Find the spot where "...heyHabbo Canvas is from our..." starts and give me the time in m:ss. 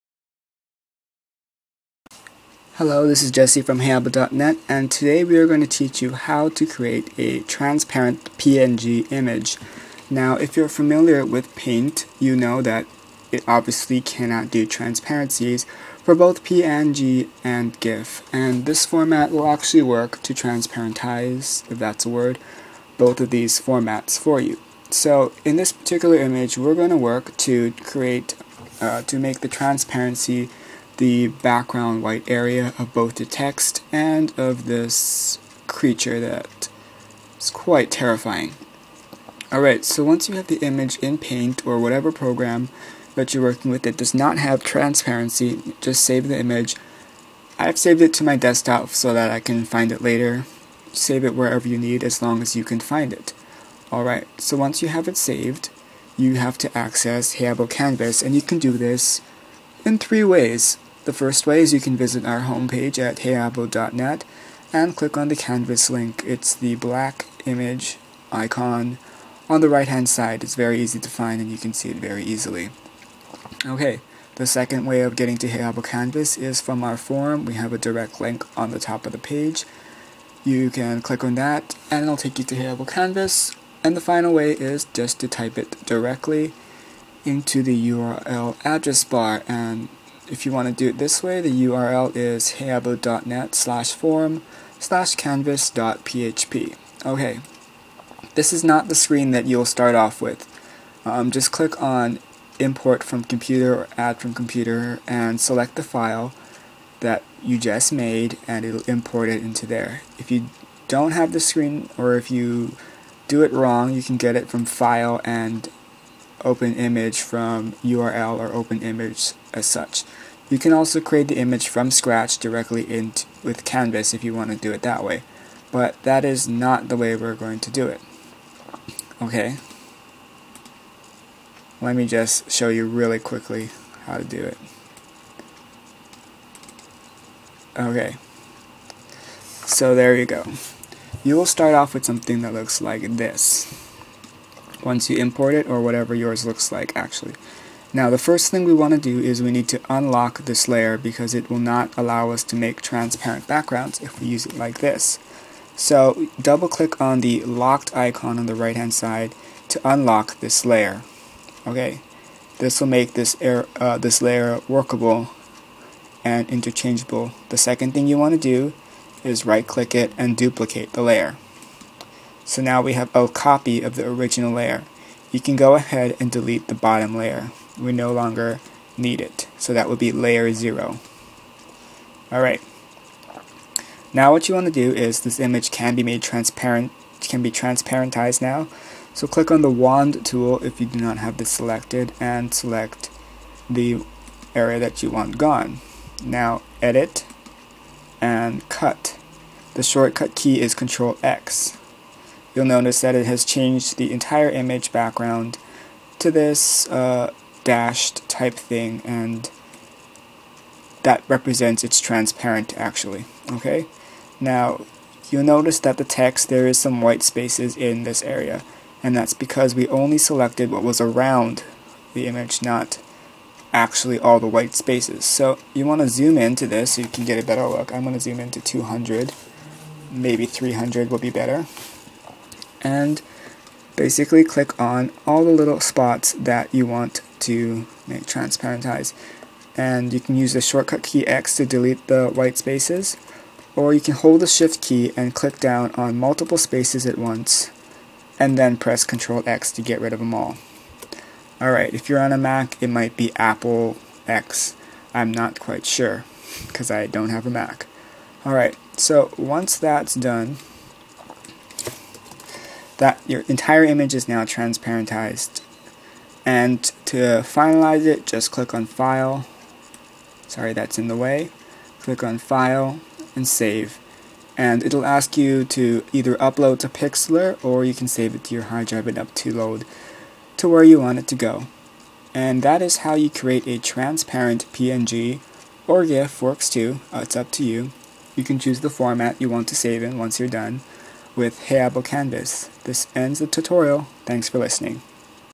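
1:15.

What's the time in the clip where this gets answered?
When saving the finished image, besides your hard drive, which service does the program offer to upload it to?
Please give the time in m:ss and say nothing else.
4:36.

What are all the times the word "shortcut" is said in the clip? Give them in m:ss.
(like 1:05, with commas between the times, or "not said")
3:19, 4:00.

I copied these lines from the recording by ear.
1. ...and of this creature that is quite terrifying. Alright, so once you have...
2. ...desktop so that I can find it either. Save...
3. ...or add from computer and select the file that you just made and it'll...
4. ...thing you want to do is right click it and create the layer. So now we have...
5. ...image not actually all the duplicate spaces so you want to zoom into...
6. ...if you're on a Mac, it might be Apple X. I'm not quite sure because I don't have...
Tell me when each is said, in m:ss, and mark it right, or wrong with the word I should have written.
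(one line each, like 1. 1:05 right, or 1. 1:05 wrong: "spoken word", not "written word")
1. 0:33 right
2. 0:48 wrong: "later", not "either"
3. 1:43 right
4. 2:47 wrong: "duplicate", not "create"
5. 3:42 wrong: "white", not "duplicate"
6. 4:11 right.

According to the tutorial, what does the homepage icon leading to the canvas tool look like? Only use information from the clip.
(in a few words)
black image icon.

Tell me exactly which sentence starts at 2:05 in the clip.
But that is not the way we're going to do it.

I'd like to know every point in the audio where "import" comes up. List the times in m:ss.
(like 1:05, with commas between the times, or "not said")
1:42, 1:48, 2:25.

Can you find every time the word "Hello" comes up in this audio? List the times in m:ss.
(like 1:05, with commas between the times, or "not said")
0:02.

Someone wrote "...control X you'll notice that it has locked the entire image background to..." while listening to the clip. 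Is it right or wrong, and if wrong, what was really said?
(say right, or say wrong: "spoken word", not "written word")
wrong: "changed", not "locked".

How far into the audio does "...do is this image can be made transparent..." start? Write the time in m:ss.
3:04.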